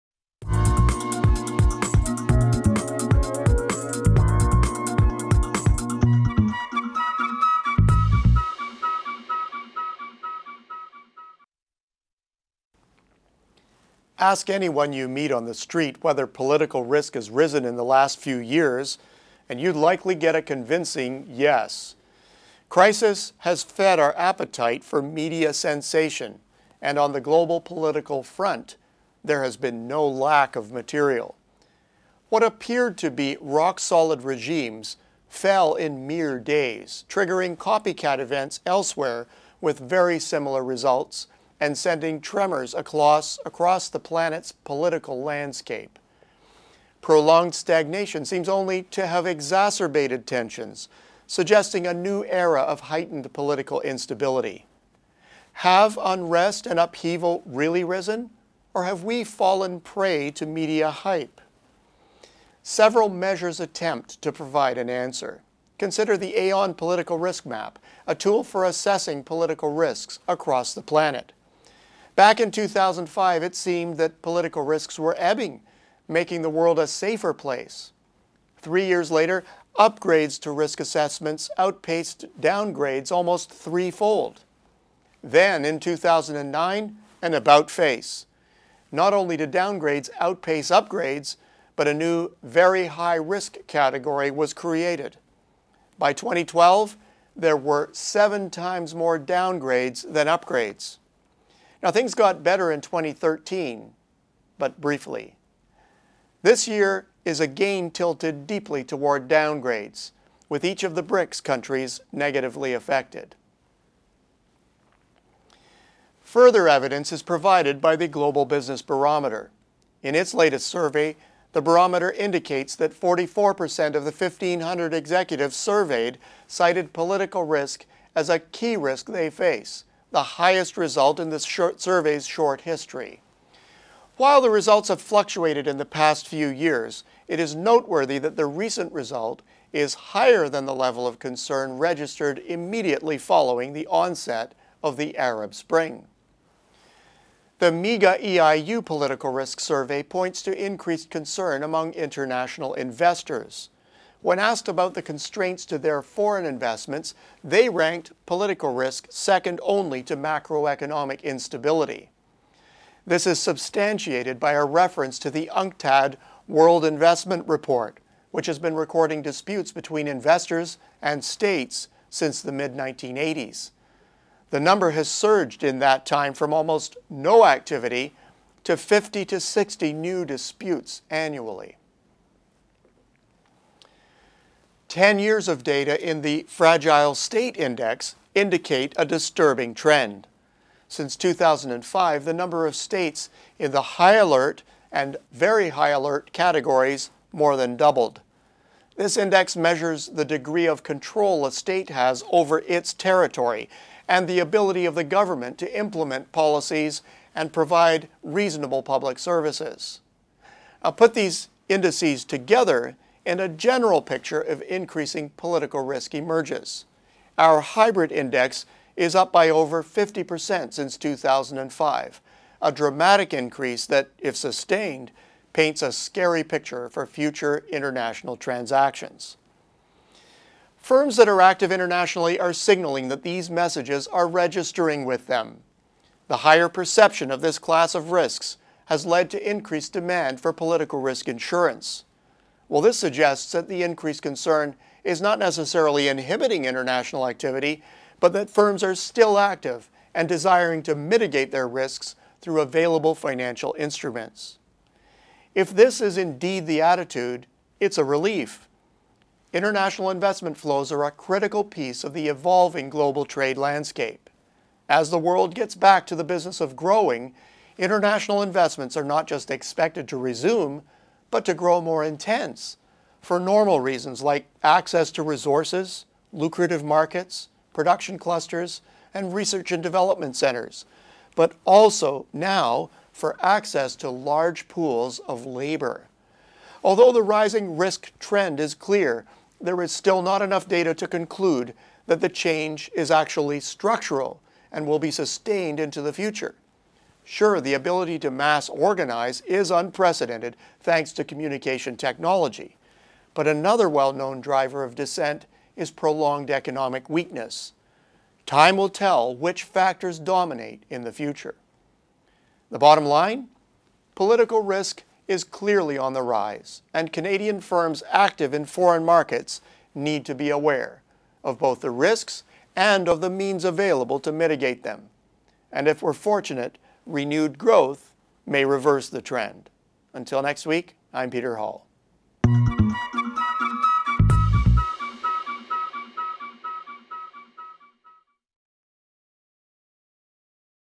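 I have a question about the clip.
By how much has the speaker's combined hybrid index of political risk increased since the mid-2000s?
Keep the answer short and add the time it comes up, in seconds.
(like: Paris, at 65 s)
over 50%, at 219 s.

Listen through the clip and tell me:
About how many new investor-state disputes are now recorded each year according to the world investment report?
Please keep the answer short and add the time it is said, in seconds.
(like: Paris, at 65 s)
50 to 60, at 178 s.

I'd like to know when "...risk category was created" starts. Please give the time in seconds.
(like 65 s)
93 s.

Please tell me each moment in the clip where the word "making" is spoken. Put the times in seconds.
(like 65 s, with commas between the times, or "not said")
76 s.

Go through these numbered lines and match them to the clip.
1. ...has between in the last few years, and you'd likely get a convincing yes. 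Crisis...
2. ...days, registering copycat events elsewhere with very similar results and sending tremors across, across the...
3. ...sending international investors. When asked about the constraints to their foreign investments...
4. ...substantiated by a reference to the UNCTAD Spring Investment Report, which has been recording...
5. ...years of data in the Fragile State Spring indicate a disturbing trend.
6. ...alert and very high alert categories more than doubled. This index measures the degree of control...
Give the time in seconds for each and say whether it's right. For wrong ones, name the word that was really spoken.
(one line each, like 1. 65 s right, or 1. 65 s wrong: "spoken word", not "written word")
1. 17 s wrong: "risen", not "between"
2. 36 s wrong: "triggering", not "registering"
3. 151 s wrong: "among", not "sending"
4. 163 s wrong: "World", not "Spring"
5. 185 s wrong: "Index", not "Spring"
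6. 194 s right.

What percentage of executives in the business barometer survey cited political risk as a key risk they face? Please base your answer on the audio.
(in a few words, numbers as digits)
44%.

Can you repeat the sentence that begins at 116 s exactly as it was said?
Further evidence is provided by the Global Business Barometer.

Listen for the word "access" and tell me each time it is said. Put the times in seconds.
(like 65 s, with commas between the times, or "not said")
274 s, 283 s.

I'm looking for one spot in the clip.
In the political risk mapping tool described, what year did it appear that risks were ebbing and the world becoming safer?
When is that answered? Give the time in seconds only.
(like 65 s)
72 s.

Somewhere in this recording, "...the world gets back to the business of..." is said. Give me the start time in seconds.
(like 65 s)
265 s.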